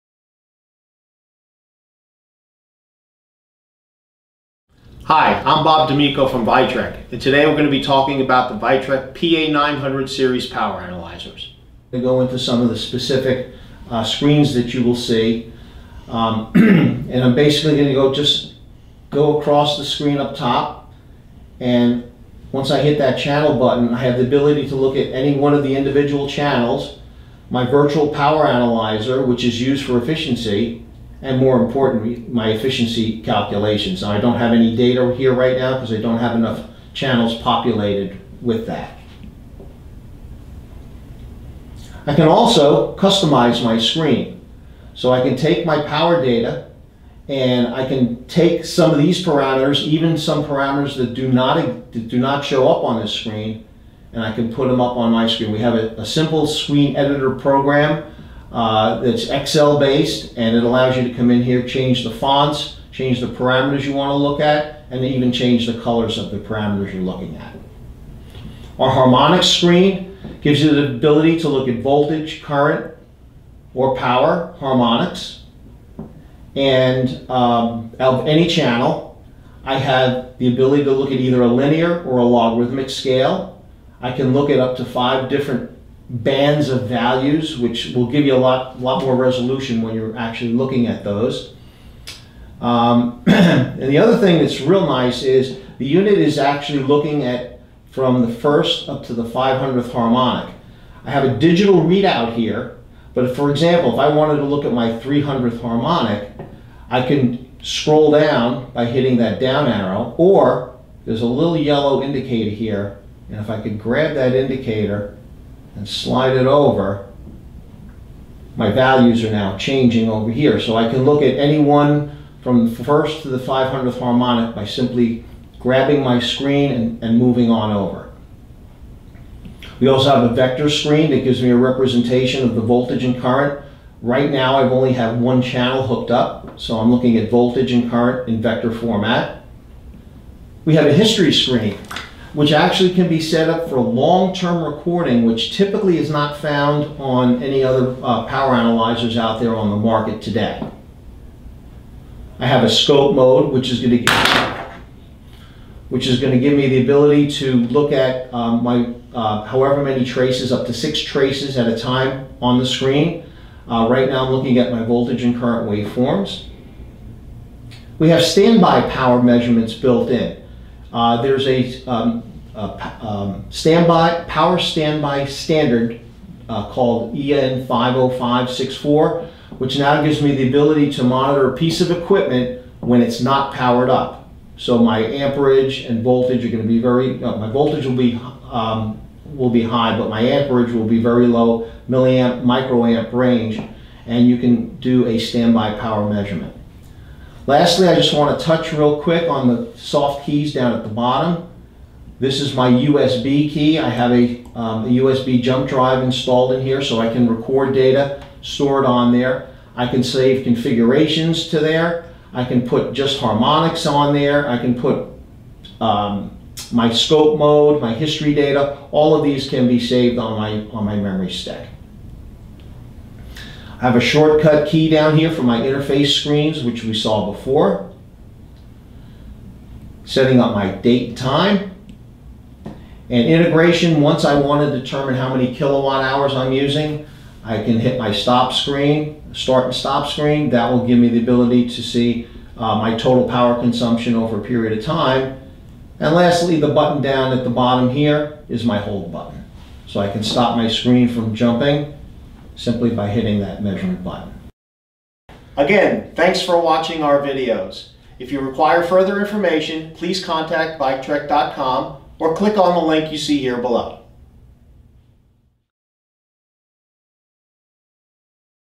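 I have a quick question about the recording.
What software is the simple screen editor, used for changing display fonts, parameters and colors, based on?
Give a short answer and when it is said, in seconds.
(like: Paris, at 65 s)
Excel, at 59 s.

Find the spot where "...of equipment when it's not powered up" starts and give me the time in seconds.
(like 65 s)
181 s.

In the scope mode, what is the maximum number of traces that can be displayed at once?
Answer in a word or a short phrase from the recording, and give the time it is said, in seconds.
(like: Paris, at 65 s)
6, at 160 s.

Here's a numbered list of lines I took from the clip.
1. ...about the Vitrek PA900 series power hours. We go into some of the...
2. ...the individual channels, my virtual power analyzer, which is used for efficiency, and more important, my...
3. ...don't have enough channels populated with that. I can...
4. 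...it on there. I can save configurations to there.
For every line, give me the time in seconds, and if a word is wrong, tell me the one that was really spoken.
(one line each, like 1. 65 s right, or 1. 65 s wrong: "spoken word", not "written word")
1. 8 s wrong: "analyzers", not "hours"
2. 25 s right
3. 36 s right
4. 208 s right.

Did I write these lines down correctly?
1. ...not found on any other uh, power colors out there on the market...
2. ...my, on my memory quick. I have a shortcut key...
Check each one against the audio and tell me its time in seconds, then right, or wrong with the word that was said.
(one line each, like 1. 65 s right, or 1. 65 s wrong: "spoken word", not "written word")
1. 146 s wrong: "analyzers", not "colors"
2. 220 s wrong: "stick", not "quick".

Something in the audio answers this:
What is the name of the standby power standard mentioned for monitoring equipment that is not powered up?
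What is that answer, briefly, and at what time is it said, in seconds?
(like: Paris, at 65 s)
EN 50564, at 177 s.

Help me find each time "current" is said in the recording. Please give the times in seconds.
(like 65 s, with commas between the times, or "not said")
72 s, 133 s, 137 s, 165 s.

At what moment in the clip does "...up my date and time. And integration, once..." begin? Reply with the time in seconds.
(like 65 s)
230 s.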